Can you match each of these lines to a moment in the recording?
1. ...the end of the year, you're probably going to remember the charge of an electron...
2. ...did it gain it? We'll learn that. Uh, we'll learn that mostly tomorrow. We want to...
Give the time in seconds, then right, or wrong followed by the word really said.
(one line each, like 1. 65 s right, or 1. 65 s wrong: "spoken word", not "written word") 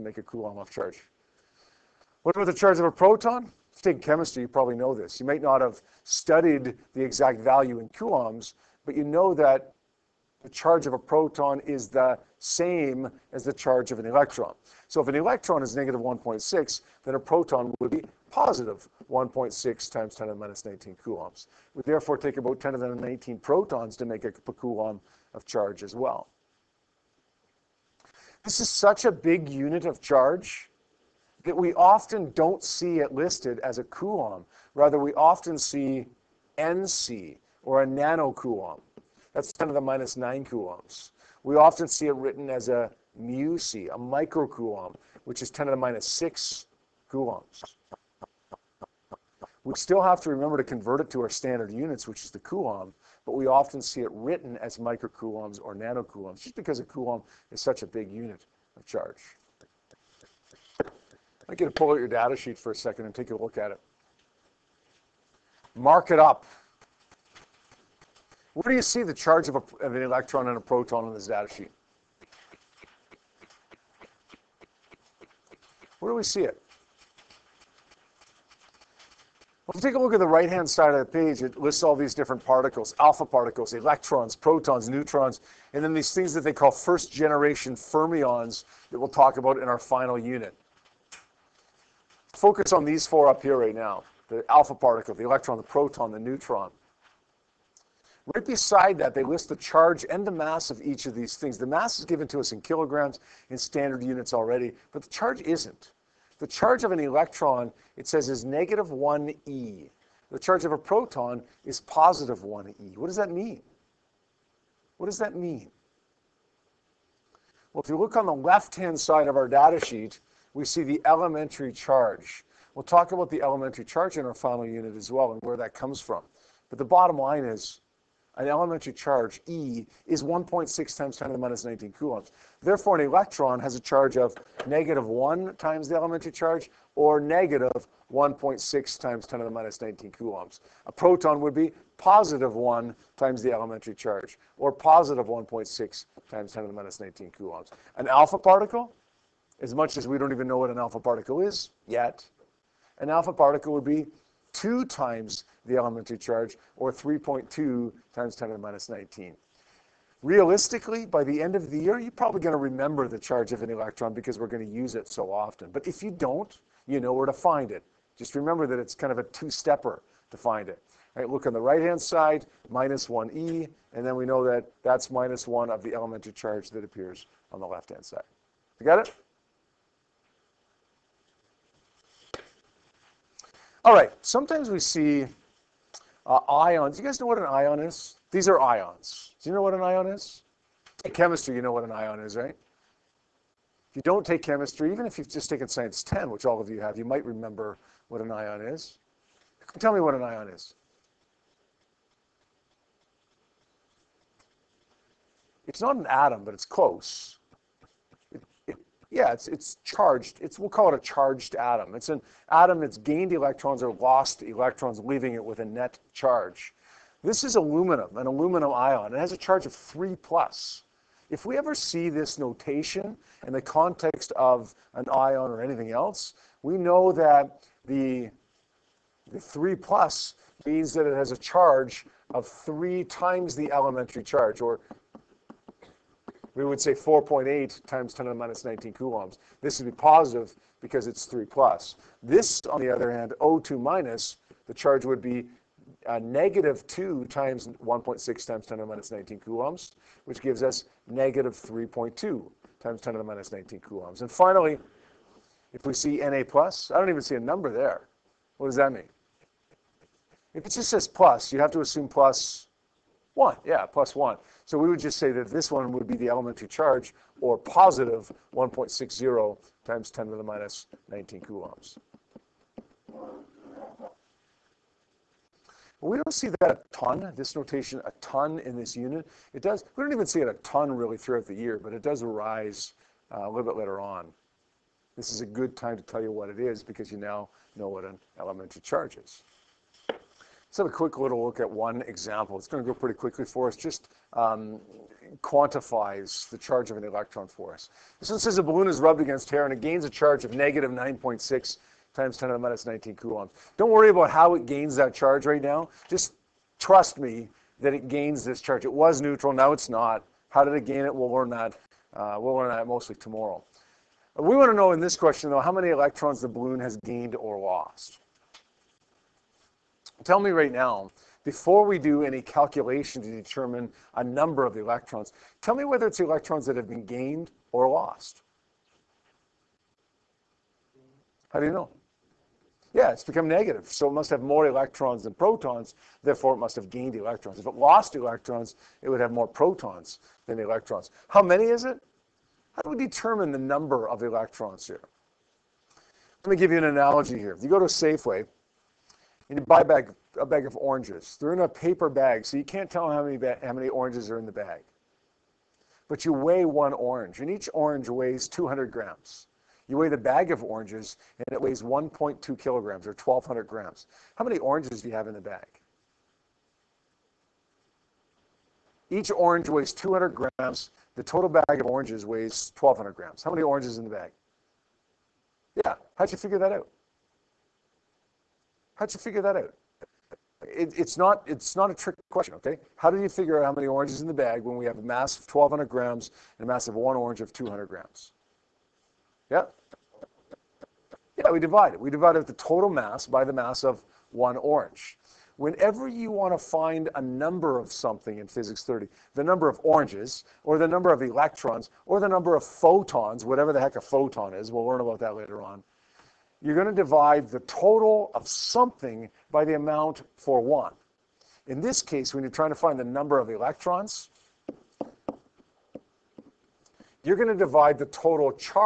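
1. 161 s right
2. 310 s right.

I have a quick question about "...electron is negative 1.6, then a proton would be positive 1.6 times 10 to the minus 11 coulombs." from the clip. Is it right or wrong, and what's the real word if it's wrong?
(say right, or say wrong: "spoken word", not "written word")
wrong: "19", not "11".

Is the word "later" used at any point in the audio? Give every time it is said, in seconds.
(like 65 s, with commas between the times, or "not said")
283 s, 405 s.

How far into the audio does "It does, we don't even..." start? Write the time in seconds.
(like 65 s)
279 s.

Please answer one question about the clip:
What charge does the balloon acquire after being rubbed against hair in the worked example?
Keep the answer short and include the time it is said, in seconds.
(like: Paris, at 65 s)
-9.6 x 10^-19 C, at 300 s.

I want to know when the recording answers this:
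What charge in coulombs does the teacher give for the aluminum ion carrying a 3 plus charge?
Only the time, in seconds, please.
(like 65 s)
236 s.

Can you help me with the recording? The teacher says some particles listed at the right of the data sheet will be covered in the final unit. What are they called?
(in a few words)
first-generation fermions.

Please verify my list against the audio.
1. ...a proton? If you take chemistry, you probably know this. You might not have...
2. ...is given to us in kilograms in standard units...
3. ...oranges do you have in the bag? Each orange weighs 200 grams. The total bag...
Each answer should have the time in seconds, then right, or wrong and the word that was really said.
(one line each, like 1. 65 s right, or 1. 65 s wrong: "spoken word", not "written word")
1. 2 s right
2. 101 s right
3. 364 s right.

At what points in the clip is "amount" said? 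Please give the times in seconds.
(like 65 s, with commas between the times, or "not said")
409 s.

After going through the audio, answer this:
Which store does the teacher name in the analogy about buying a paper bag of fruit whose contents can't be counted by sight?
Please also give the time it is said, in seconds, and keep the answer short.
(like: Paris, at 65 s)
Safeway, at 347 s.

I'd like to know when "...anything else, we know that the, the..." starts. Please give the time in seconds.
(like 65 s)
225 s.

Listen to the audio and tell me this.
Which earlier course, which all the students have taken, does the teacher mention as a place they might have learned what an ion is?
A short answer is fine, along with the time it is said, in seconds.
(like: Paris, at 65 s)
Science 10, at 195 s.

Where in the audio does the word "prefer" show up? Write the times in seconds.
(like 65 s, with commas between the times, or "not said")
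not said.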